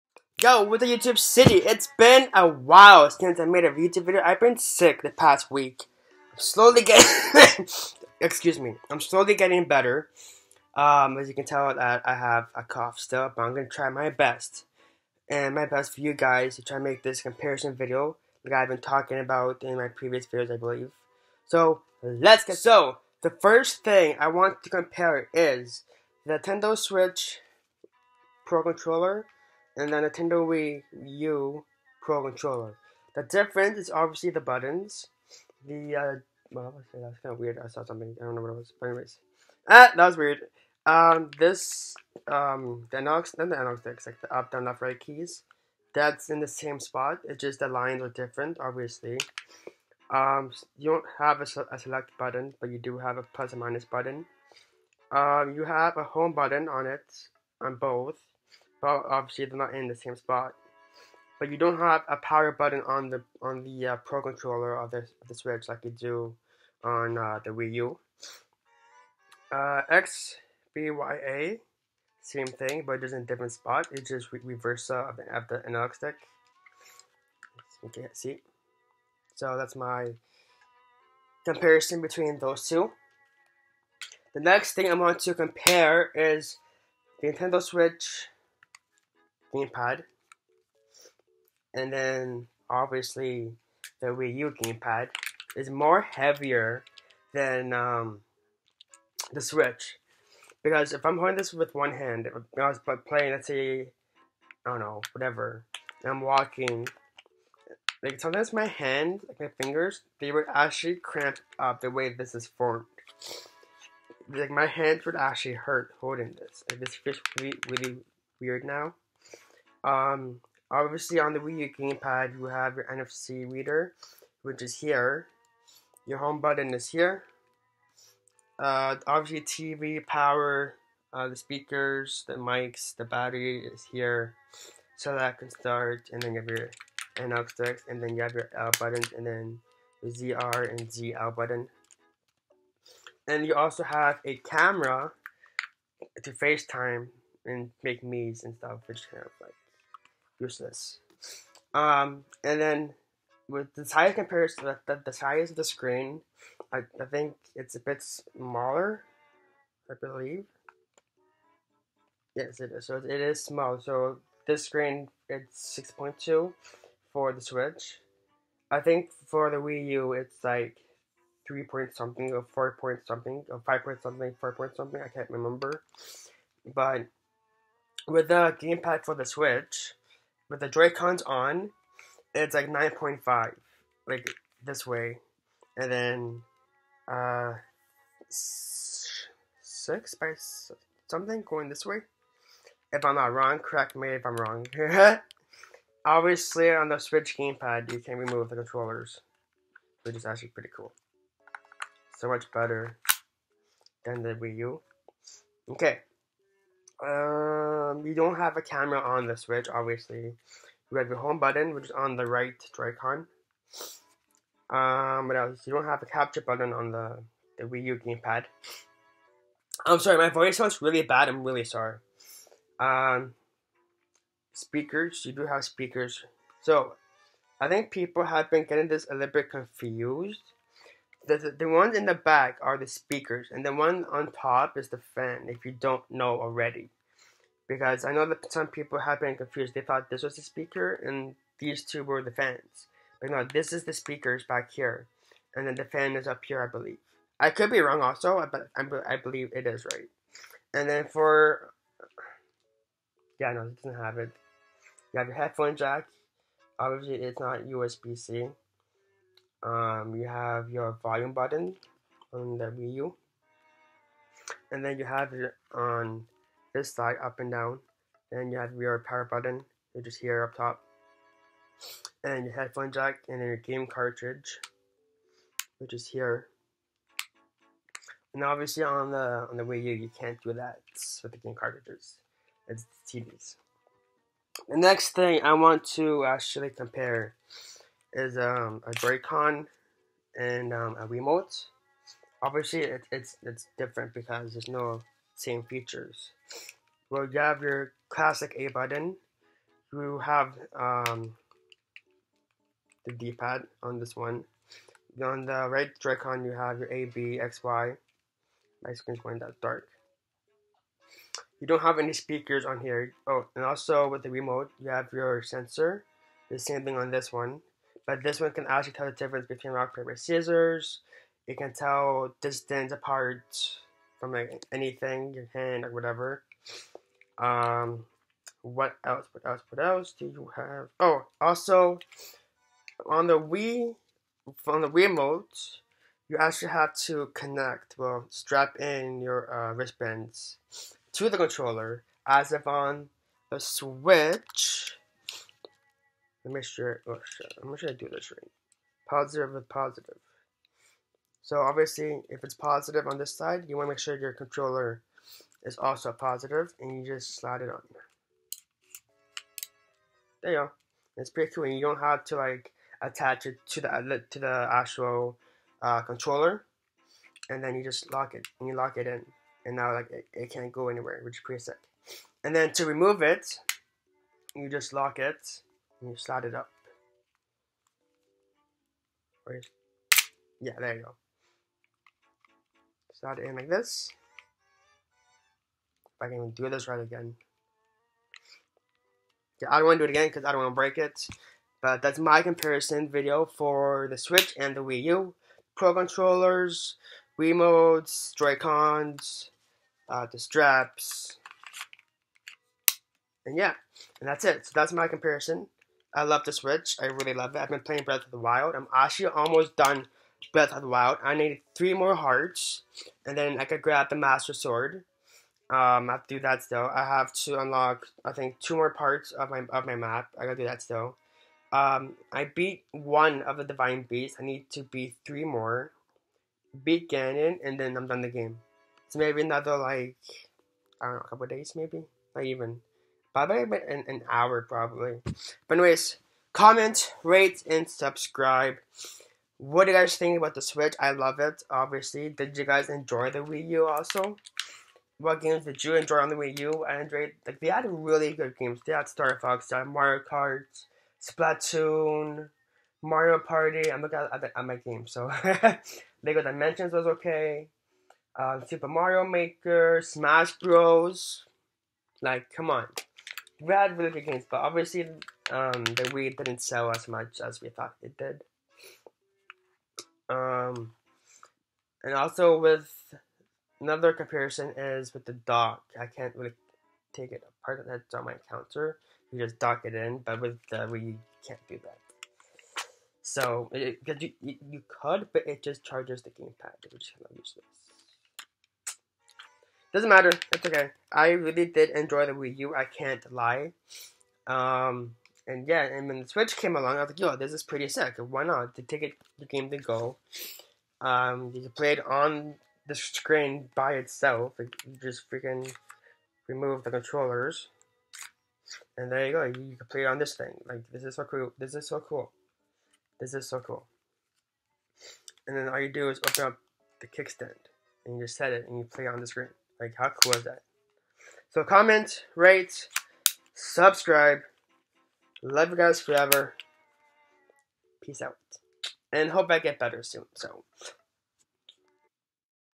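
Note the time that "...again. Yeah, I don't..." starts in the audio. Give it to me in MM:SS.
06:26.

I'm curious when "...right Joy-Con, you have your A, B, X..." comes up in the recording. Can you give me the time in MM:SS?
05:05.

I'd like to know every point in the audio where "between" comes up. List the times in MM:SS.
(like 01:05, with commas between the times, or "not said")
01:22, 05:19.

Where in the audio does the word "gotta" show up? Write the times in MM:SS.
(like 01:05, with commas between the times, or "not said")
07:00.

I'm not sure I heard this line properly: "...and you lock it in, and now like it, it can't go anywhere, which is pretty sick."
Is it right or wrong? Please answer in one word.
right.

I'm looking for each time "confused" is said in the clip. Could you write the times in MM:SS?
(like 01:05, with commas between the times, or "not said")
03:49, 03:59.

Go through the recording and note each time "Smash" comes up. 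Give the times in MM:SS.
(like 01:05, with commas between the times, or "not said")
07:40.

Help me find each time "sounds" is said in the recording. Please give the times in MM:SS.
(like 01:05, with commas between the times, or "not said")
03:40.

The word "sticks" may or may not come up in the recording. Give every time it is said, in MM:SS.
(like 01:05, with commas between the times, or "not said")
00:43, 01:15.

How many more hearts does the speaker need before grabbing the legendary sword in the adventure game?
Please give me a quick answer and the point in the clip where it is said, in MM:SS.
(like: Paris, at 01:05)
3, at 06:51.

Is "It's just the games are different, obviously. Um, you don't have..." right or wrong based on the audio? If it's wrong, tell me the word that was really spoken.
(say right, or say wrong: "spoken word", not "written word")
wrong: "lines", not "games".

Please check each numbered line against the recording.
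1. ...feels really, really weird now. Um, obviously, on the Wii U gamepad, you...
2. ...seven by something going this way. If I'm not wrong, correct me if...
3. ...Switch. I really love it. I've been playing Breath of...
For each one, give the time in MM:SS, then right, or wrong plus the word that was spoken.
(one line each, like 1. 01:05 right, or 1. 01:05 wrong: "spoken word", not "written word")
1. 01:56 right
2. 03:08 wrong: "six", not "seven"
3. 06:46 right.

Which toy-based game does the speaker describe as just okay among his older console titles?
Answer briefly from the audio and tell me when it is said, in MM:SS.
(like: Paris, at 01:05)
Lego Dimensions, at 07:36.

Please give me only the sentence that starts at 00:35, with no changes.
The, uh, well, that's kind of weird.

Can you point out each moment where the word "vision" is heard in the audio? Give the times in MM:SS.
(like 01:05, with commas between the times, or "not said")
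not said.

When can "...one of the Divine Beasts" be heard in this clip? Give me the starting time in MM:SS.
07:02.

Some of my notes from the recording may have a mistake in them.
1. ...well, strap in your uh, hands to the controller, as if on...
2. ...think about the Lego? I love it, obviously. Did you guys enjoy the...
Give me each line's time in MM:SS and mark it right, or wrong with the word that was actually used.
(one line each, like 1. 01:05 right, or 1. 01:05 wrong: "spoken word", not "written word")
1. 05:37 wrong: "wristbands", not "hands"
2. 07:20 wrong: "Switch", not "Lego".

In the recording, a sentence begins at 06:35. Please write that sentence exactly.
Pro controllers, Wiimotes, Joy-Cons, uh, the straps.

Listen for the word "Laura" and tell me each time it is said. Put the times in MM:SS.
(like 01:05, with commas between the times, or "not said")
not said.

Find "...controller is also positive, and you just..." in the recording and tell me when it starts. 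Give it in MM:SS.
05:54.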